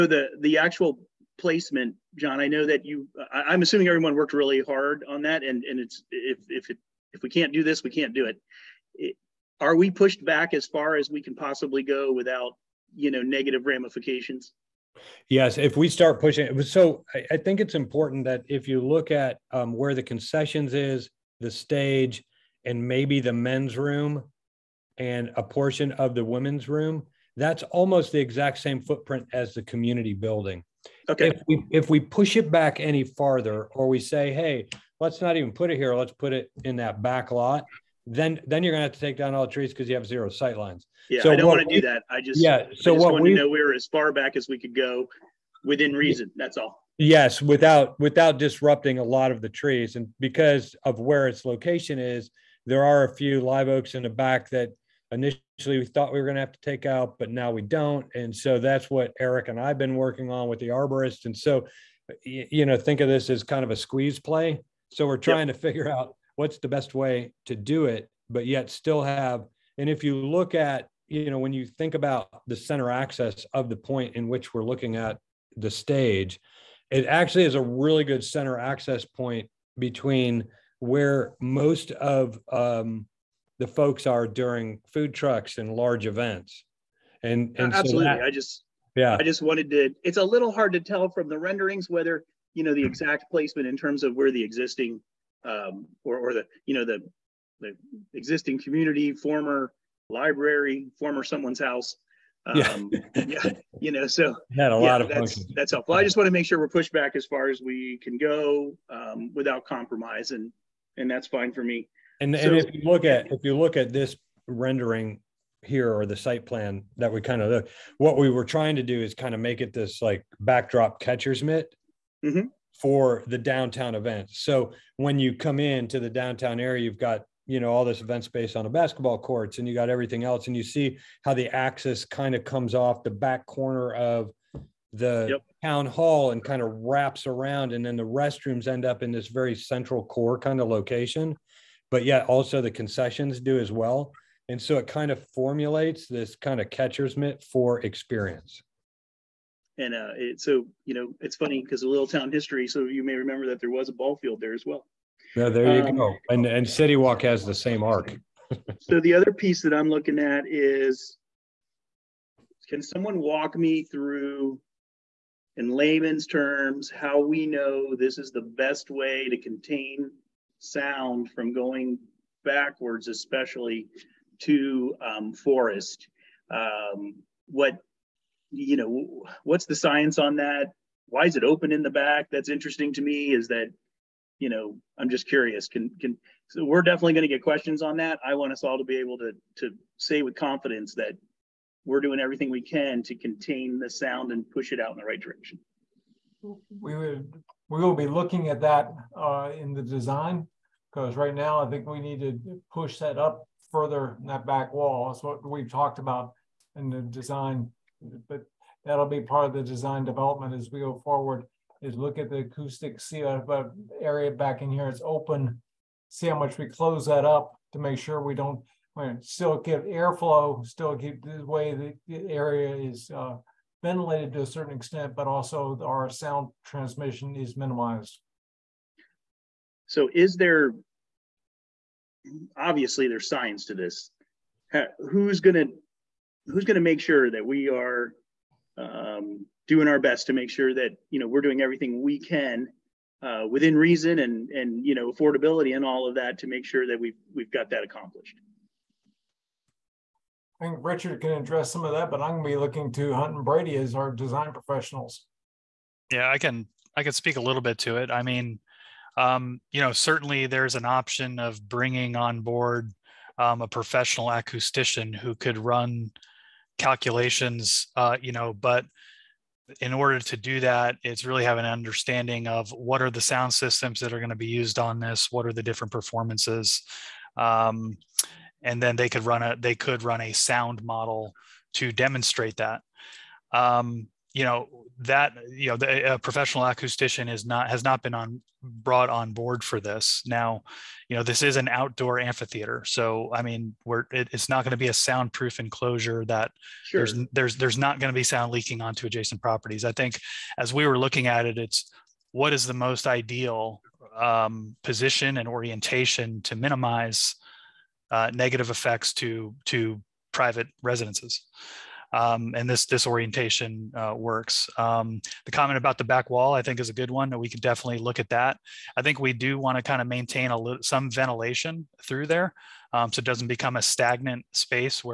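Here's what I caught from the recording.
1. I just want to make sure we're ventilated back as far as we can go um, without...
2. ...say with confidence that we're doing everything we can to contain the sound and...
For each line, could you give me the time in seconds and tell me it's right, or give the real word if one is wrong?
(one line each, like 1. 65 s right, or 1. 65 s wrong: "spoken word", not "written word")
1. 105 s wrong: "pushed", not "ventilated"
2. 189 s right.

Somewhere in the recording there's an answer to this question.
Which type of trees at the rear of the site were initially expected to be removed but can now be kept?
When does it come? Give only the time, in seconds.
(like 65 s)
53 s.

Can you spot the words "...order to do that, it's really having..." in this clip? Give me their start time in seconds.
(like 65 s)
269 s.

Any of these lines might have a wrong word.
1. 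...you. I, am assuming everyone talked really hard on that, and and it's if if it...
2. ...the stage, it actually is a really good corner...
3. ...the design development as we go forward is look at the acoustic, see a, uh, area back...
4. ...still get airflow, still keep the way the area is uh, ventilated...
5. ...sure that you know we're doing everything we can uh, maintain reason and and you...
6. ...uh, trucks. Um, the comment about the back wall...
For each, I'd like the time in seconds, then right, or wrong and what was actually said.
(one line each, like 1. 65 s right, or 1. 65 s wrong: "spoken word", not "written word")
1. 2 s wrong: "worked", not "talked"
2. 75 s wrong: "center", not "corner"
3. 209 s right
4. 219 s right
5. 240 s wrong: "within", not "maintain"
6. 313 s wrong: "works", not "trucks".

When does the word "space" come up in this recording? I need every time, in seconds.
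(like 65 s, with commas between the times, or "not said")
128 s, 324 s.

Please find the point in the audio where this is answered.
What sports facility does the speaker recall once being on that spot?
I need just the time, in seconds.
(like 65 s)
153 s.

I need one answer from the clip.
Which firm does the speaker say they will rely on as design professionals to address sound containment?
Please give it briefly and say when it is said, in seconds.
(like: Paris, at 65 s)
Hunton Brady, at 253 s.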